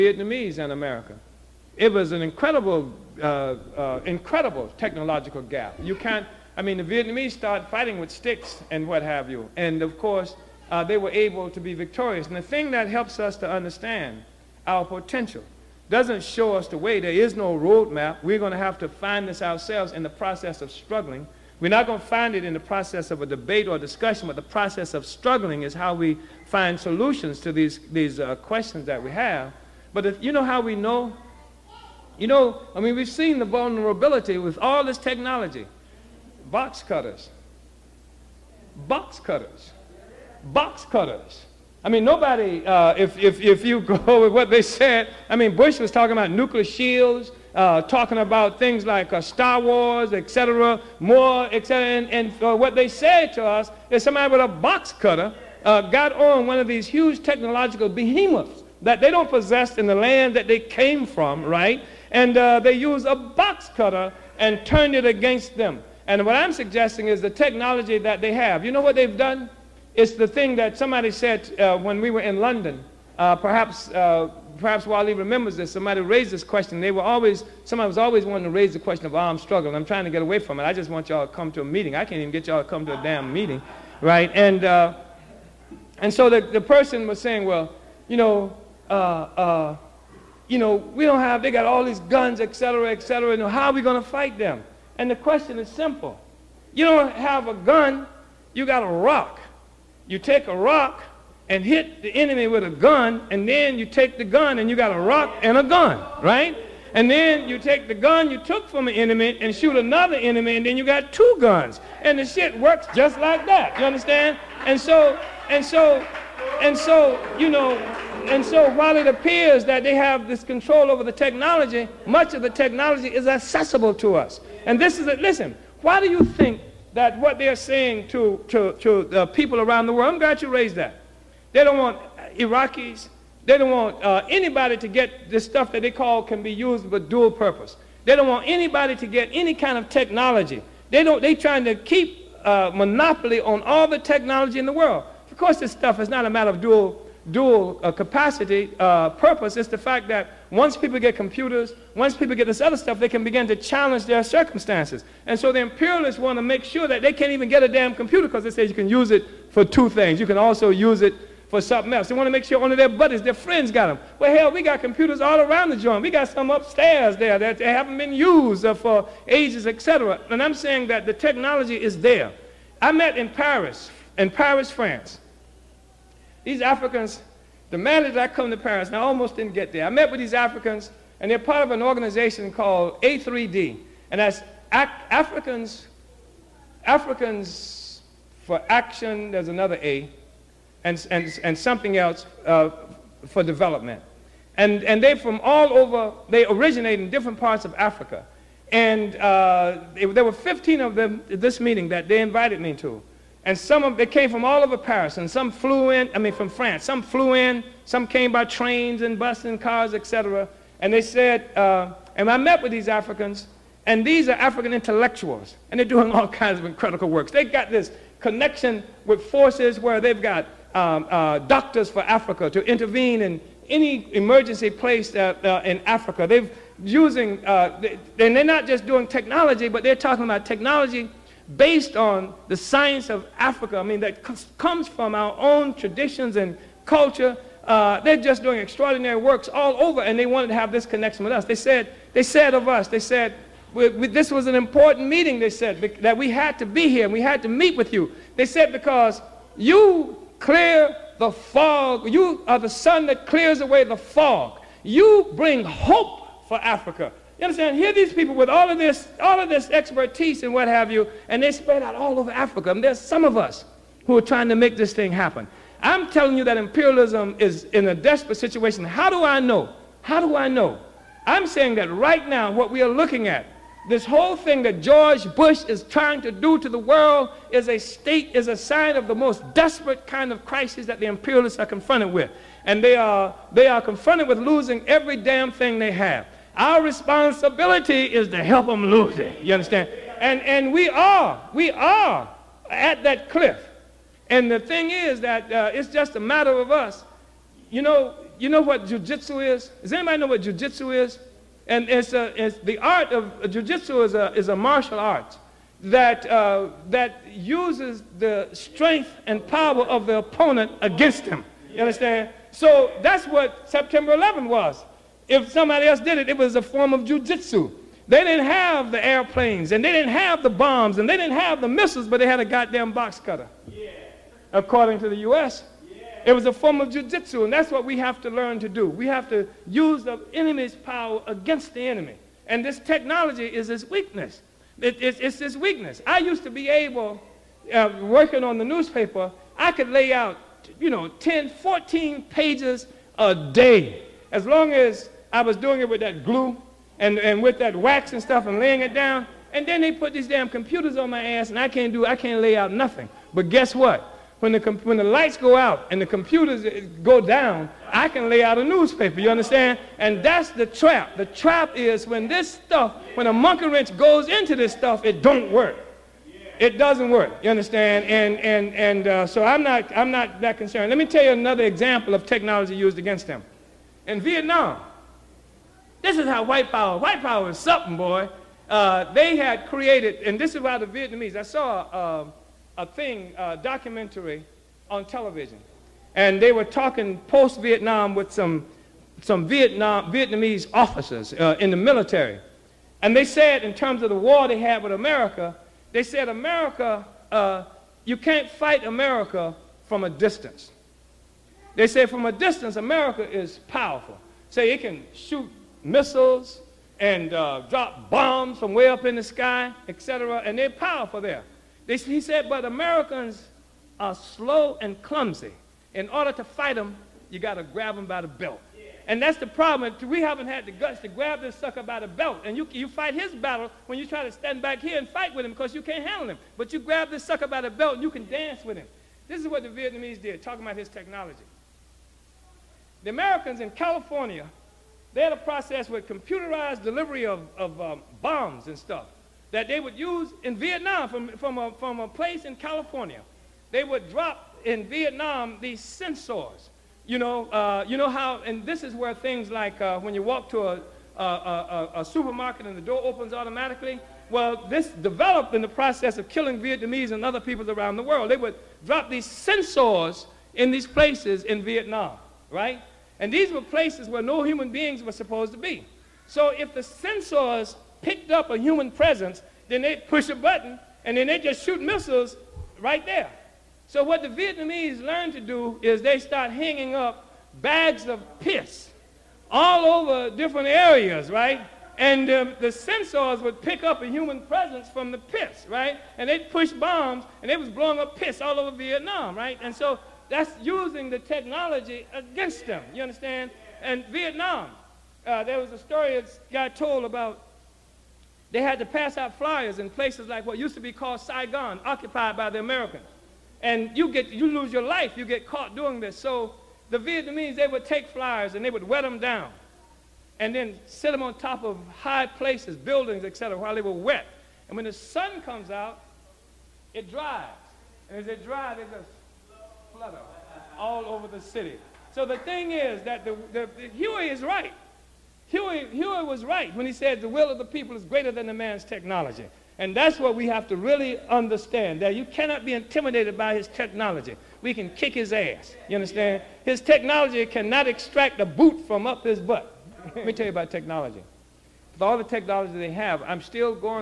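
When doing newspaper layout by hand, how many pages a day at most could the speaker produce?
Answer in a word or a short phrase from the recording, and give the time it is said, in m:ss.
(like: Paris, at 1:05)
14, at 5:41.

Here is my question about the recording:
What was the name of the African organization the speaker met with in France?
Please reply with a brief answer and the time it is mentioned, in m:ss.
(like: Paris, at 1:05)
A3D, at 3:03.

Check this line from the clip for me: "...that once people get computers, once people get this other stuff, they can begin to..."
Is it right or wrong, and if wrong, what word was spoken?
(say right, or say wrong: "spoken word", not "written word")
right.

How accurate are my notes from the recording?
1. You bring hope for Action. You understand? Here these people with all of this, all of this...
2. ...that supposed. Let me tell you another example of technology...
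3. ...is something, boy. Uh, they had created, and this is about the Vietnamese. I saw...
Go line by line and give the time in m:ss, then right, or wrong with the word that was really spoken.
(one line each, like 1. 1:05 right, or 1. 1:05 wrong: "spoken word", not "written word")
1. 4:14 wrong: "Africa", not "Action"
2. 6:10 wrong: "concerned", not "supposed"
3. 6:17 right.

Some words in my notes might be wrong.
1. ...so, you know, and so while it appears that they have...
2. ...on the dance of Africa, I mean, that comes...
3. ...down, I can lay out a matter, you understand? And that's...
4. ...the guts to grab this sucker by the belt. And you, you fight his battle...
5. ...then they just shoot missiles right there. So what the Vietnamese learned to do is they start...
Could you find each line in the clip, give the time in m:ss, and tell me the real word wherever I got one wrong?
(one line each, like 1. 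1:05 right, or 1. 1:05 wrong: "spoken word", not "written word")
1. 1:56 right
2. 3:51 wrong: "science", not "dance"
3. 5:57 wrong: "newspaper", not "matter"
4. 7:00 right
5. 7:51 right.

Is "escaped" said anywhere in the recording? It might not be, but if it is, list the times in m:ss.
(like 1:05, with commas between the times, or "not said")
not said.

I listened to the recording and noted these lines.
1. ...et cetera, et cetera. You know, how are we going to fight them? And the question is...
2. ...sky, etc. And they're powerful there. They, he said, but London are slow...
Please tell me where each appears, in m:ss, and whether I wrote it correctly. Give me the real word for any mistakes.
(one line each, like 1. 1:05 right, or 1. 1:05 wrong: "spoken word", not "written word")
1. 1:32 right
2. 6:49 wrong: "Americans", not "London".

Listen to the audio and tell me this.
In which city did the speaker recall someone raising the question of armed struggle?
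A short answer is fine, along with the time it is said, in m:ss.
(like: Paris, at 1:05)
London, at 1:12.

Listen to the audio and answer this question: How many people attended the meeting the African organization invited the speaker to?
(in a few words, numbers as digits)
15.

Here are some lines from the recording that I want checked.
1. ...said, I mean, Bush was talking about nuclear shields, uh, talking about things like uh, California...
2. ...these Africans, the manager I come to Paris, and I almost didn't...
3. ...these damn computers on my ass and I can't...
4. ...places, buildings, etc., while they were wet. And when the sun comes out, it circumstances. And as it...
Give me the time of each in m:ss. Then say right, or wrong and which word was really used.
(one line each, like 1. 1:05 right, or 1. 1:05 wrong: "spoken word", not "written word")
1. 0:44 wrong: "Star", not "California"
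2. 2:56 right
3. 5:50 right
4. 8:32 wrong: "dries", not "circumstances".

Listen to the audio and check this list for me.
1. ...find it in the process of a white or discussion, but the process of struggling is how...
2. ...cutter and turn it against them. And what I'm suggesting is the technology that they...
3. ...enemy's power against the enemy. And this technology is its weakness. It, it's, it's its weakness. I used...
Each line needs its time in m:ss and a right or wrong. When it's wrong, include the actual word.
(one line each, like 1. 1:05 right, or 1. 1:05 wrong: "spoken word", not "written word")
1. 0:22 wrong: "debate", not "white"
2. 1:03 right
3. 5:30 right.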